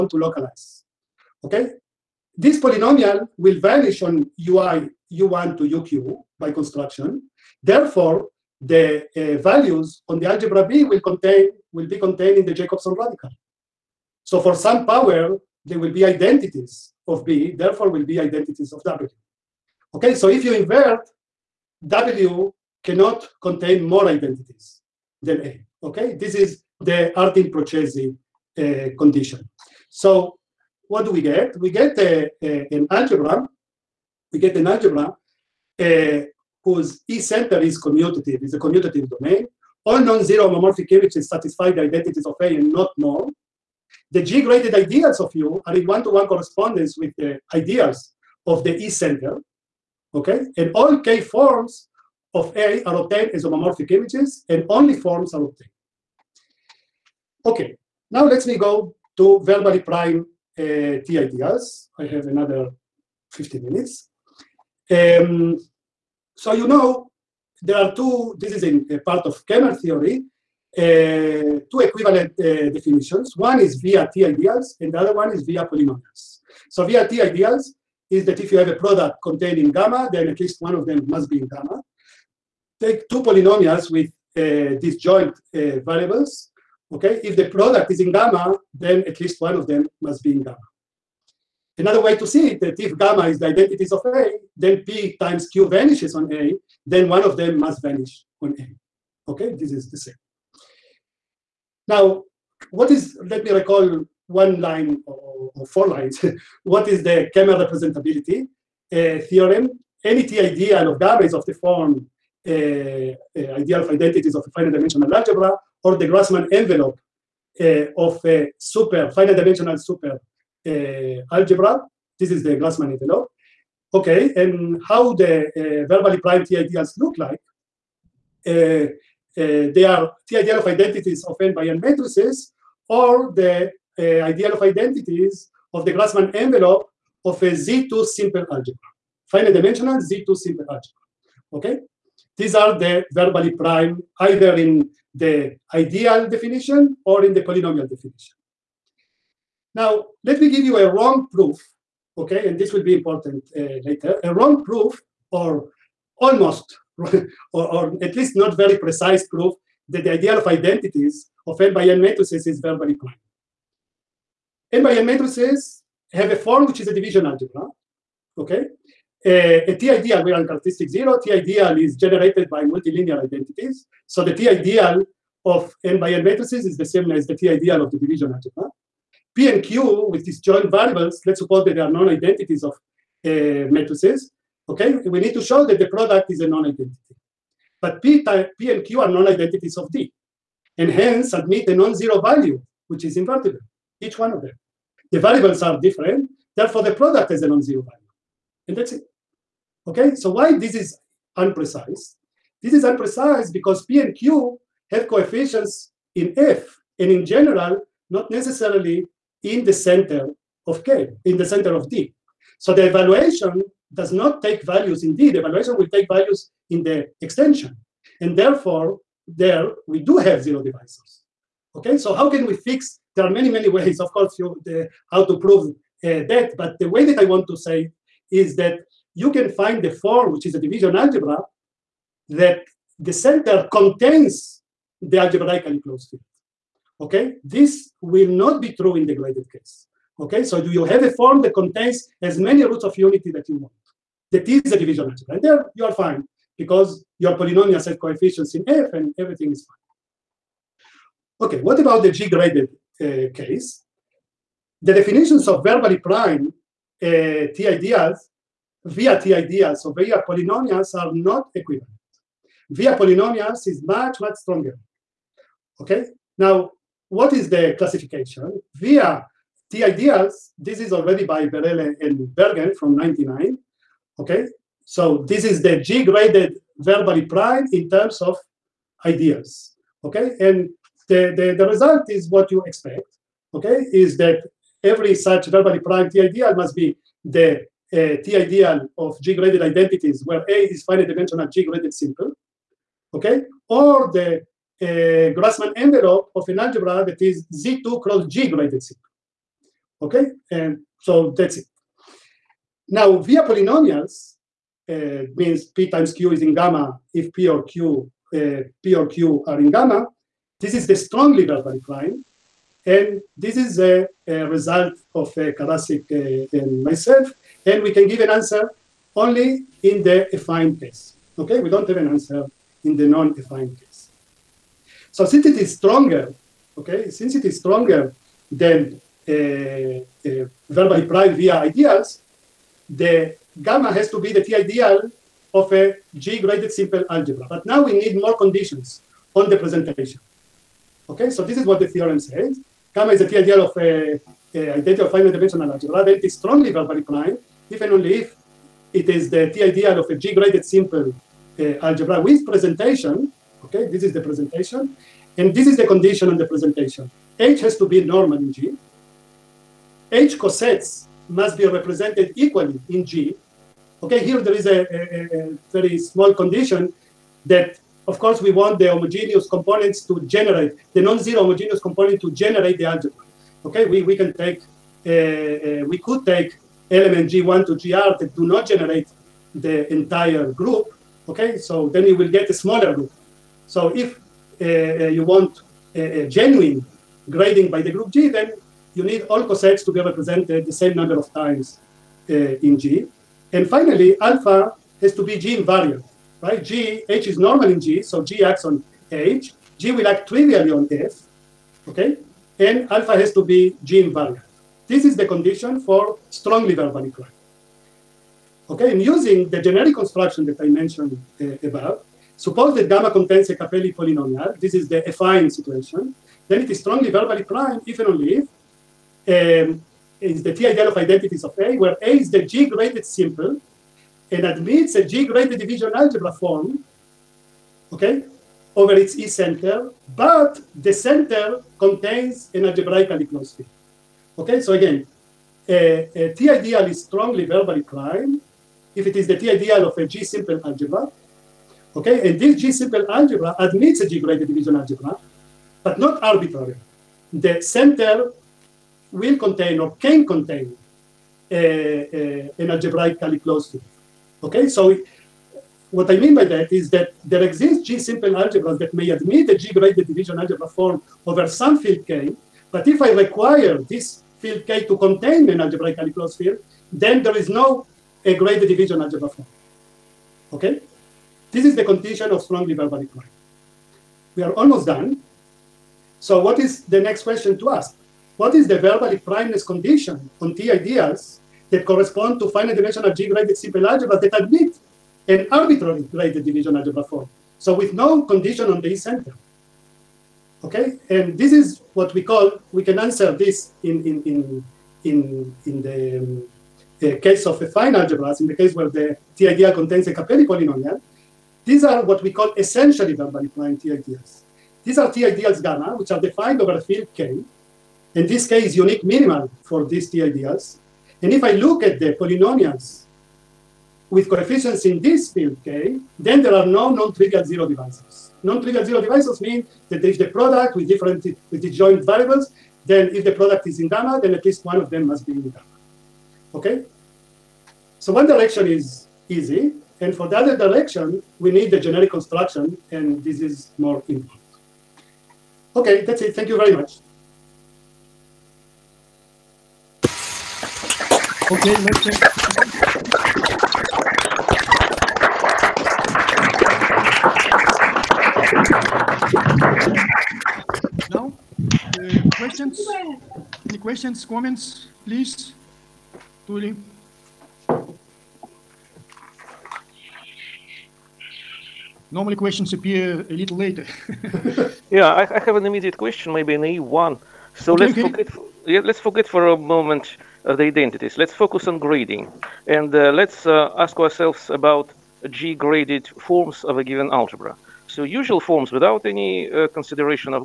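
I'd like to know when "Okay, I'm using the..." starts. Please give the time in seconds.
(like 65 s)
408 s.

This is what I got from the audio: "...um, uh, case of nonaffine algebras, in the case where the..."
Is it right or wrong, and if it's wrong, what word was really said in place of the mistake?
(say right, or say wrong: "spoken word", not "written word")
wrong: "affine", not "nonaffine".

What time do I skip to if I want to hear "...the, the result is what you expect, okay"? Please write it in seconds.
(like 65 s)
281 s.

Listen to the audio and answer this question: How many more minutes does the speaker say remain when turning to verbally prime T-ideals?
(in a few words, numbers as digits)
15.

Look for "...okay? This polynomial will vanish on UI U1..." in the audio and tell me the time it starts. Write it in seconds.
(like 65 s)
1 s.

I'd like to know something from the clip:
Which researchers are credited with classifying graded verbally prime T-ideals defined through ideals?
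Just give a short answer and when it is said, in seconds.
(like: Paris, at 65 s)
Berele and Bergen, at 271 s.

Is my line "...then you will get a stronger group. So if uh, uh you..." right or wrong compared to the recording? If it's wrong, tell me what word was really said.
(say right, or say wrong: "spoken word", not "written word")
wrong: "smaller", not "stronger".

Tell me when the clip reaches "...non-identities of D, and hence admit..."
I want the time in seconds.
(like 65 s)
189 s.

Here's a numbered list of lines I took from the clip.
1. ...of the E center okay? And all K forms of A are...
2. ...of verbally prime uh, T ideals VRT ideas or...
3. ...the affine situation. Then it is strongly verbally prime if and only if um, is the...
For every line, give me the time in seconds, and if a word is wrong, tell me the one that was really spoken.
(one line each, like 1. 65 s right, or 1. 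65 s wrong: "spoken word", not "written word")
1. 48 s right
2. 255 s right
3. 414 s right.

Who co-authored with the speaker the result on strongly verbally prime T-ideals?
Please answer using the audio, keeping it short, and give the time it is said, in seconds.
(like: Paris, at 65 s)
Karasik, at 315 s.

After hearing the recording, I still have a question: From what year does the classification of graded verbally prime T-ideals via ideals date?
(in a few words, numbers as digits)
1999.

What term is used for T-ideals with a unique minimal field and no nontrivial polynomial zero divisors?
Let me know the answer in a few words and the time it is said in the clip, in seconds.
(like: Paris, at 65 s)
essentially verbally prime, at 502 s.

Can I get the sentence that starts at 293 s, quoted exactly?
Or the uh, Grassman Grassmann envelope of an algebra that is Z2 cross G graded simple, okay?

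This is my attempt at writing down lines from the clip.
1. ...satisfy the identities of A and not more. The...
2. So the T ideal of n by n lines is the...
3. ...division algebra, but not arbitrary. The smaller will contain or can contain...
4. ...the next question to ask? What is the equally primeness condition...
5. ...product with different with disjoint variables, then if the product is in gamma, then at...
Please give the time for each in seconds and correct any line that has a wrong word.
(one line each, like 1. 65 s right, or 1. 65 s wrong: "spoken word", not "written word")
1. 41 s right
2. 174 s wrong: "matrices", not "lines"
3. 444 s wrong: "center", not "smaller"
4. 476 s wrong: "verbally", not "equally"
5. 520 s right.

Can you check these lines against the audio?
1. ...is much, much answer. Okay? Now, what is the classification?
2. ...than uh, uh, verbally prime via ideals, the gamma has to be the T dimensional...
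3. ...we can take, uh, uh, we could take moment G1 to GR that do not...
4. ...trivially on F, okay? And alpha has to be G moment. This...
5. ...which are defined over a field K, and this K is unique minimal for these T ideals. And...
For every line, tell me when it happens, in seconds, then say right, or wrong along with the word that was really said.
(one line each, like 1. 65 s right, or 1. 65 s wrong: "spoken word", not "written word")
1. 263 s wrong: "stronger", not "answer"
2. 328 s wrong: "ideal", not "dimensional"
3. 374 s wrong: "element", not "moment"
4. 400 s wrong: "invariant", not "moment"
5. 505 s right.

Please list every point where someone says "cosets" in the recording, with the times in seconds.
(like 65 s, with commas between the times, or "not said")
360 s, 389 s.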